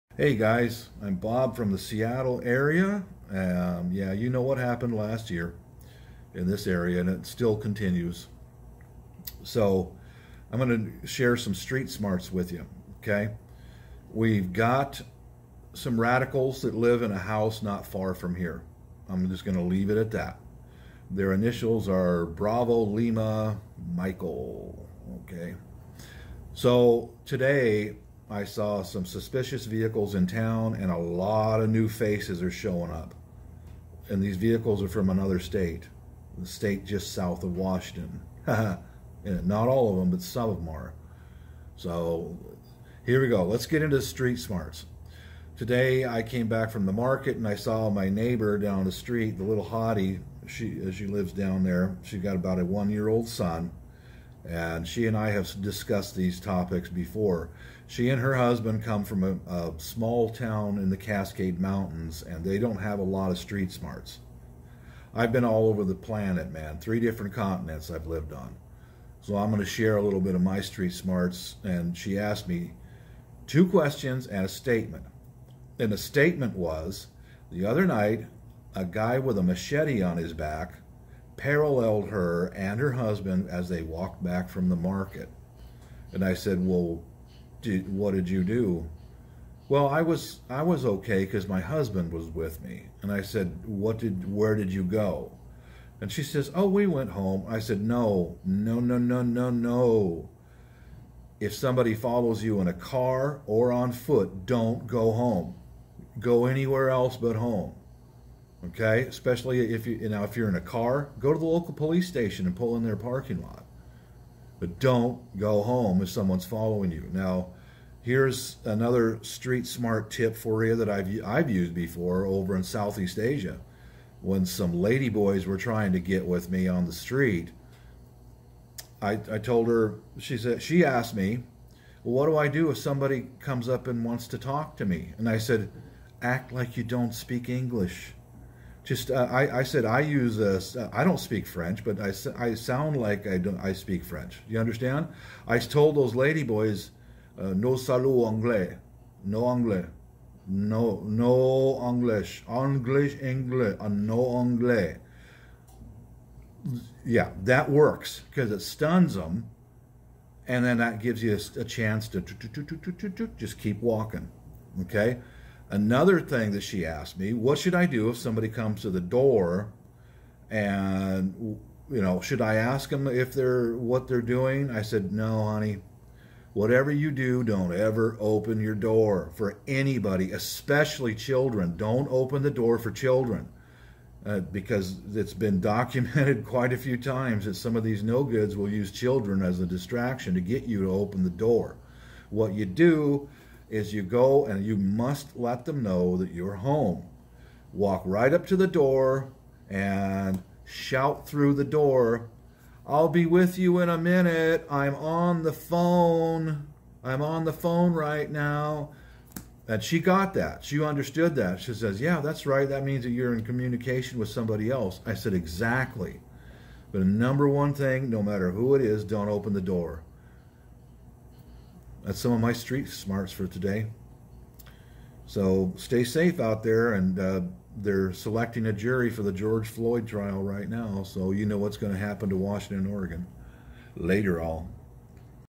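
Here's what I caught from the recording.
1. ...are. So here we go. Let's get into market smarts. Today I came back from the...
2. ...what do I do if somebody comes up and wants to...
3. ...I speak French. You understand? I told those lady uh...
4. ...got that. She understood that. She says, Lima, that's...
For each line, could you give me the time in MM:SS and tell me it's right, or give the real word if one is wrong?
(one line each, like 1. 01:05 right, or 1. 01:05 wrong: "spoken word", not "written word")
1. 00:40 wrong: "street", not "market"
2. 02:12 right
3. 02:23 right
4. 03:29 wrong: "Yeah", not "Lima".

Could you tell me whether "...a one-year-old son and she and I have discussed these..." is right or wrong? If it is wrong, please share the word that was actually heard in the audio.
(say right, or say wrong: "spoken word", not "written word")
right.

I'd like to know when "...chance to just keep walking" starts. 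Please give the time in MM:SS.
02:41.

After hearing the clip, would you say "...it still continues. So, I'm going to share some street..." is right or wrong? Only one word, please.
right.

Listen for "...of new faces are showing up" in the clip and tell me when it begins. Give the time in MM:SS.
00:31.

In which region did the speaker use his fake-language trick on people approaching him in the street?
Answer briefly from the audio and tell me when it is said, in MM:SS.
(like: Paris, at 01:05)
Southeast Asia, at 02:02.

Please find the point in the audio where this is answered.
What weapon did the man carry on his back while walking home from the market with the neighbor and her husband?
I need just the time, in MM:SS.
01:19.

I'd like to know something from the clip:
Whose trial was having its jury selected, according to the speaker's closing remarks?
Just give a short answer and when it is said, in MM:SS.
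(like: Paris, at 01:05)
George Floyd, at 03:49.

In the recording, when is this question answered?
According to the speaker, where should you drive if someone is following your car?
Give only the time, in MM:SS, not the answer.
01:51.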